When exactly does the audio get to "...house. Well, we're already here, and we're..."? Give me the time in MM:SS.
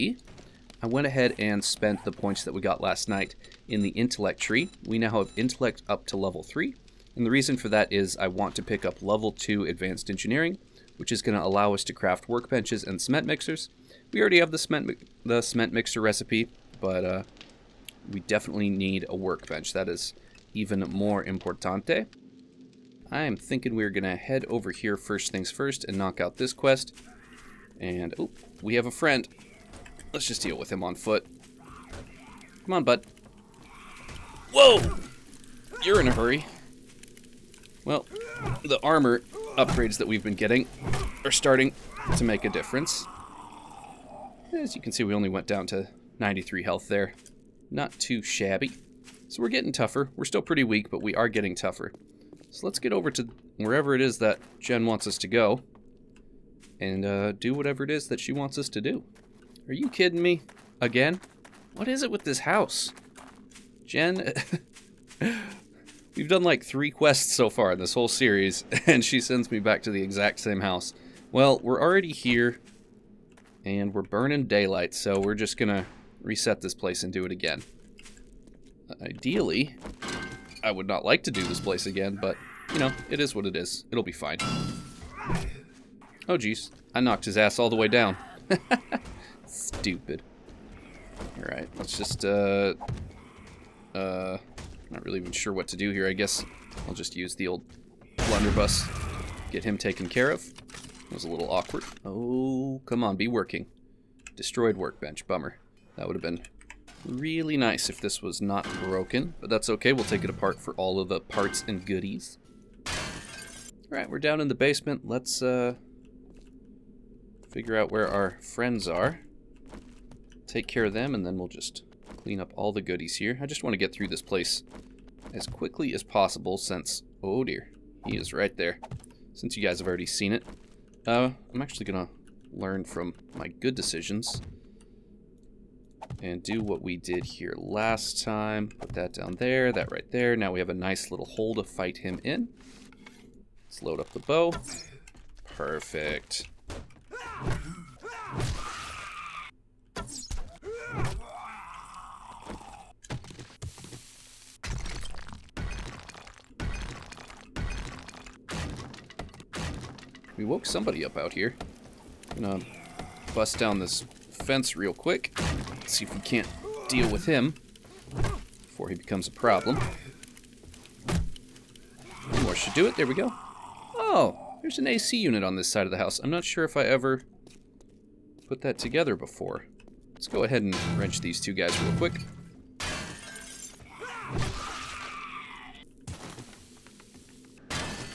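01:10.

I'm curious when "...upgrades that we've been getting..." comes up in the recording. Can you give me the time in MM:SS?
00:39.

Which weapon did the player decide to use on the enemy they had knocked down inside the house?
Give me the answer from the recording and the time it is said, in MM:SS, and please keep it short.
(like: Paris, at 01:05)
blunderbuss, at 01:38.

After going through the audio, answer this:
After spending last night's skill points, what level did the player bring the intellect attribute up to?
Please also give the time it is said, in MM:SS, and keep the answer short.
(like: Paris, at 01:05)
3, at 00:06.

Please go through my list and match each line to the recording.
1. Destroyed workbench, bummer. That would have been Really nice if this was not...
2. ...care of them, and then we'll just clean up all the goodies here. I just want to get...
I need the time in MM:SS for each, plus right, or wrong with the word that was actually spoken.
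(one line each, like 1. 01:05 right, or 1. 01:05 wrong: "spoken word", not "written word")
1. 01:44 right
2. 02:00 right.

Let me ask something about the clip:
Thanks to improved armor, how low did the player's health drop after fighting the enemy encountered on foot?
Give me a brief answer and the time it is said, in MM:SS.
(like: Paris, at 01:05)
93, at 00:46.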